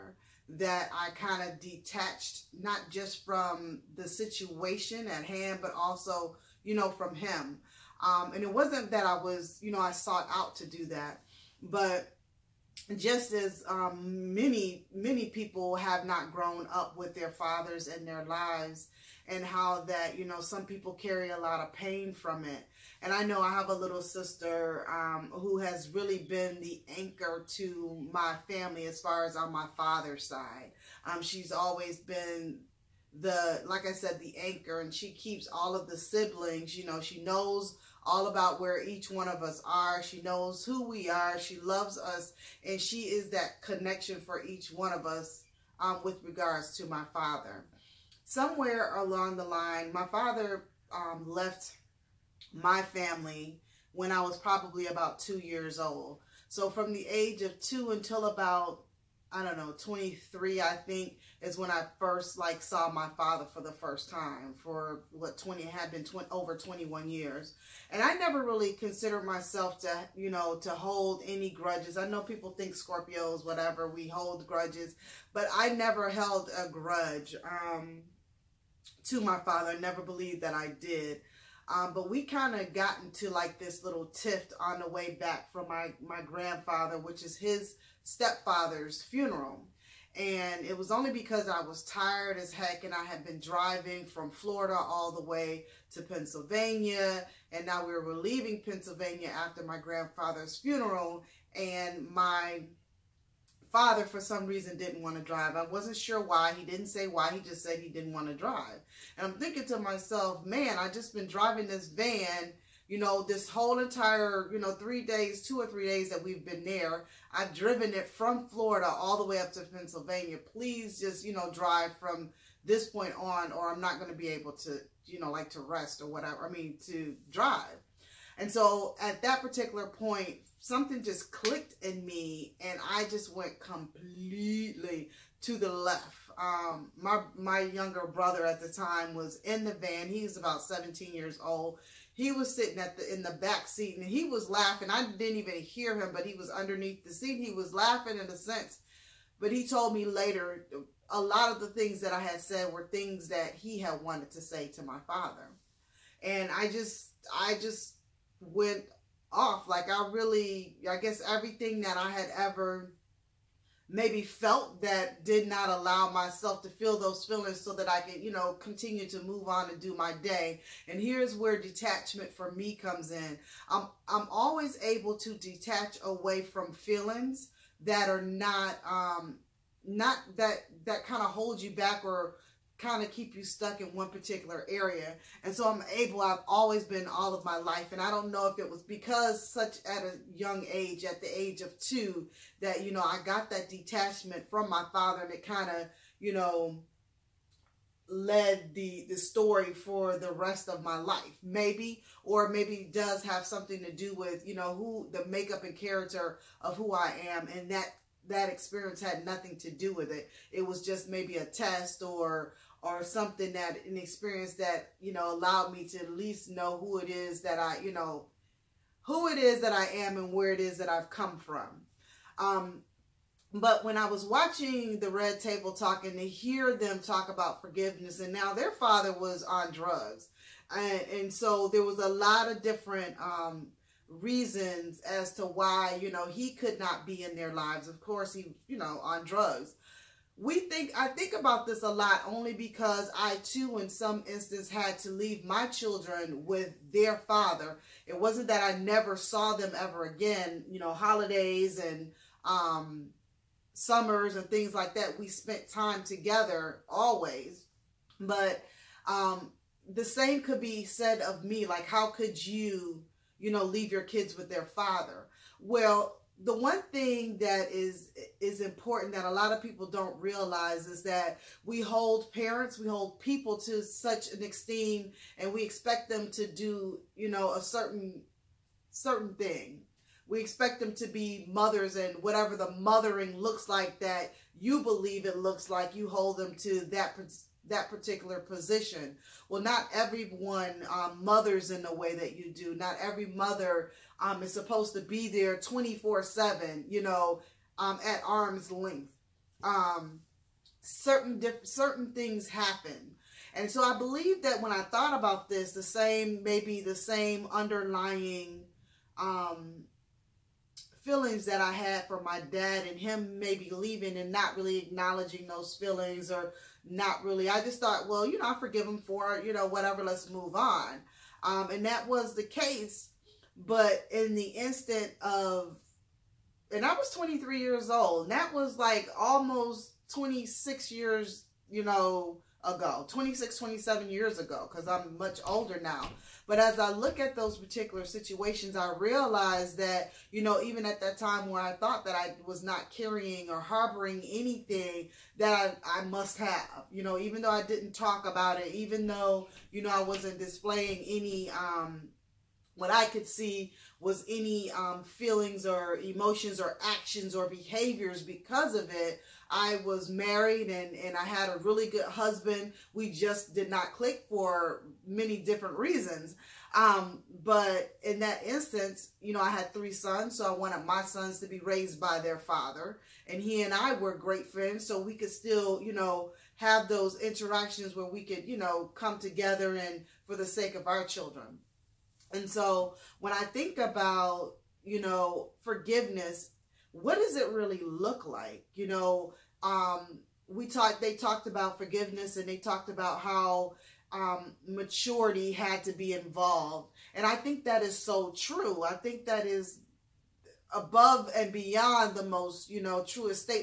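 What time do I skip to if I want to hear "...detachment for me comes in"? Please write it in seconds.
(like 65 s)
171 s.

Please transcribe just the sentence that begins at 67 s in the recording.
And I never really considered myself to, you know, to hold any grudges.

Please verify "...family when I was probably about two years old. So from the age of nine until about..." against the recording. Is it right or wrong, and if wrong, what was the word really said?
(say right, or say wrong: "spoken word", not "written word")
wrong: "two", not "nine".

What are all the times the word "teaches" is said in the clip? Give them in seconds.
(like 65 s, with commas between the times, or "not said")
not said.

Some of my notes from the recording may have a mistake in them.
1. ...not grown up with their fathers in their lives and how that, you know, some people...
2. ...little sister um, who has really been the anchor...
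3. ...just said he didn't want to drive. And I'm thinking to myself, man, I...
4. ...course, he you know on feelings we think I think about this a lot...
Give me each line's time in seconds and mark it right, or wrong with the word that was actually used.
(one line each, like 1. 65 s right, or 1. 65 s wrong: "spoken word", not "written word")
1. 16 s right
2. 23 s right
3. 107 s right
4. 237 s wrong: "drugs", not "feelings".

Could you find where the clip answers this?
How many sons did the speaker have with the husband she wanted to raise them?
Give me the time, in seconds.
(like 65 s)
369 s.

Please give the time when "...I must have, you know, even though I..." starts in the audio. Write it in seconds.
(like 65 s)
345 s.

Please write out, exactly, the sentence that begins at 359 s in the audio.
I was married and, and I had a really good husband.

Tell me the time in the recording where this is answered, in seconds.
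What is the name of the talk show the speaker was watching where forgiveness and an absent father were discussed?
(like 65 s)
225 s.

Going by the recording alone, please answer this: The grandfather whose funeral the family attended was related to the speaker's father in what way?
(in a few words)
Stepfather.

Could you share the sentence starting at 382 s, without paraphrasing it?
And so when I think about, you know, forgiveness, what does it really look like?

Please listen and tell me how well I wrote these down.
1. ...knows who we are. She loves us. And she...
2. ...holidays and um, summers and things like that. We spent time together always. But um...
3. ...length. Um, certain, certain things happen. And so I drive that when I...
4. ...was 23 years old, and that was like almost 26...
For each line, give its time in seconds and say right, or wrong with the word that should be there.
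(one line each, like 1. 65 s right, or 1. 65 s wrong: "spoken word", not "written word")
1. 40 s right
2. 250 s right
3. 298 s wrong: "believe", not "drive"
4. 326 s right.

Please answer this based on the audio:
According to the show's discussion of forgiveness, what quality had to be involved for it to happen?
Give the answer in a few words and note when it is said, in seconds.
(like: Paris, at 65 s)
Maturity, at 394 s.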